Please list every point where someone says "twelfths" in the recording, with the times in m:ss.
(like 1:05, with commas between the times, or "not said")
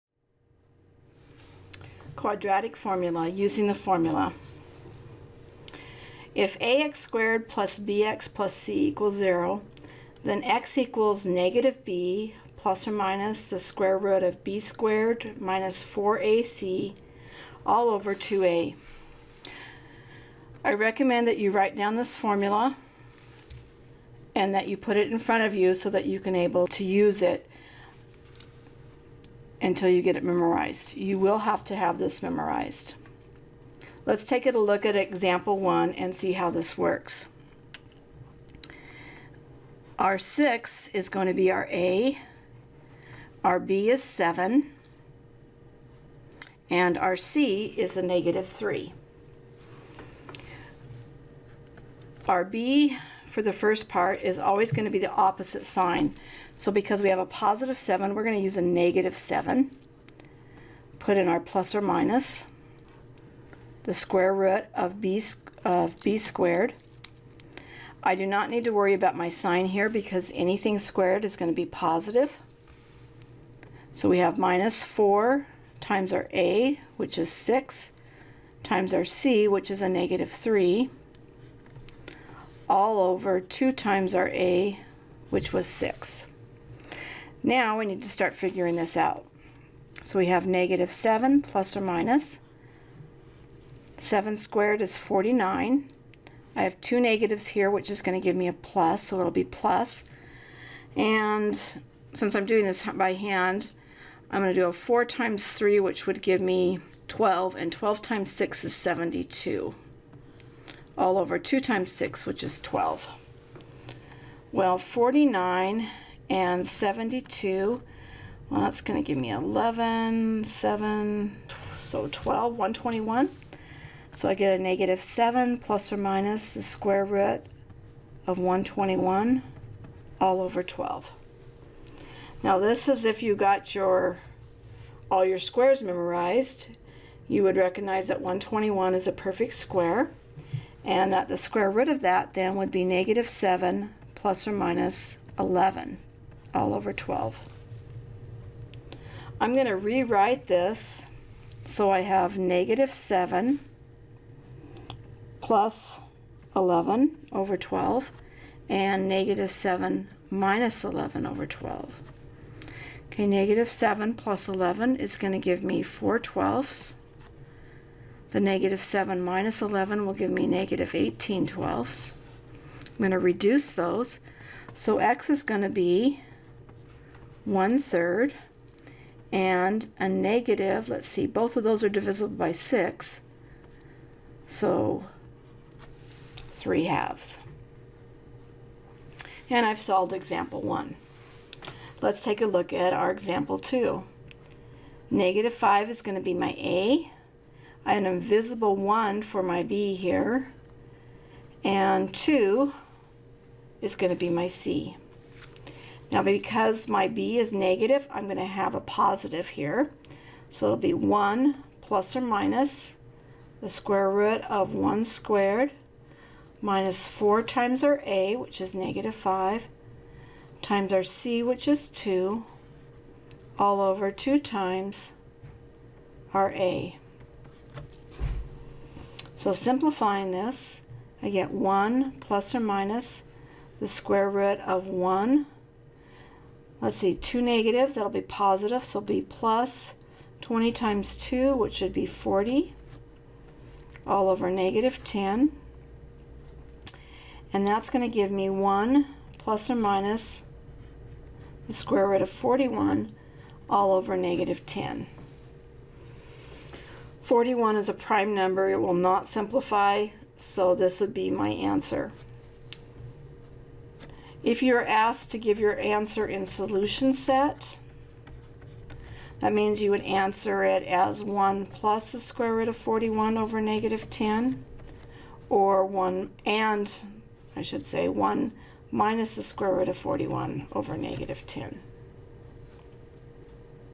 2:46, 2:51.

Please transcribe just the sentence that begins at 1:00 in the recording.
Put in our plus or minus the square root of b, of b squared.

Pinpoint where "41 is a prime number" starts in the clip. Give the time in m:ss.
4:17.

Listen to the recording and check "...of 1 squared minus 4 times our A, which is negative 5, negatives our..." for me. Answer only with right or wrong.
wrong.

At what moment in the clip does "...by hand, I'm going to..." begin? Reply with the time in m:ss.
1:42.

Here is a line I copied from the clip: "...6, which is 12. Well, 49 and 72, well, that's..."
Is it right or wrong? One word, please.
right.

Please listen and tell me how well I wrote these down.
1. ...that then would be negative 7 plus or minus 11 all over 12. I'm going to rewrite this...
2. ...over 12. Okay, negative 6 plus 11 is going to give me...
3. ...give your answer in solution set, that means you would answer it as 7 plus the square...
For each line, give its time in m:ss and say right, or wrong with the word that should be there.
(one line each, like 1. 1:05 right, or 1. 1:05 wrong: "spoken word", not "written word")
1. 2:22 right
2. 2:41 wrong: "7", not "6"
3. 4:25 wrong: "1", not "7".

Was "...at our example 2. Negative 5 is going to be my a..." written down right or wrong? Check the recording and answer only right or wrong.
right.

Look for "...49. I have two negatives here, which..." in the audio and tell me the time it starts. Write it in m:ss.
1:34.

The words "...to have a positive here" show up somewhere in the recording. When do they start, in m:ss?
3:28.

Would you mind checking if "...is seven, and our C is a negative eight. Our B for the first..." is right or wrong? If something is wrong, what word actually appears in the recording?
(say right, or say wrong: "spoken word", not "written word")
wrong: "three", not "eight".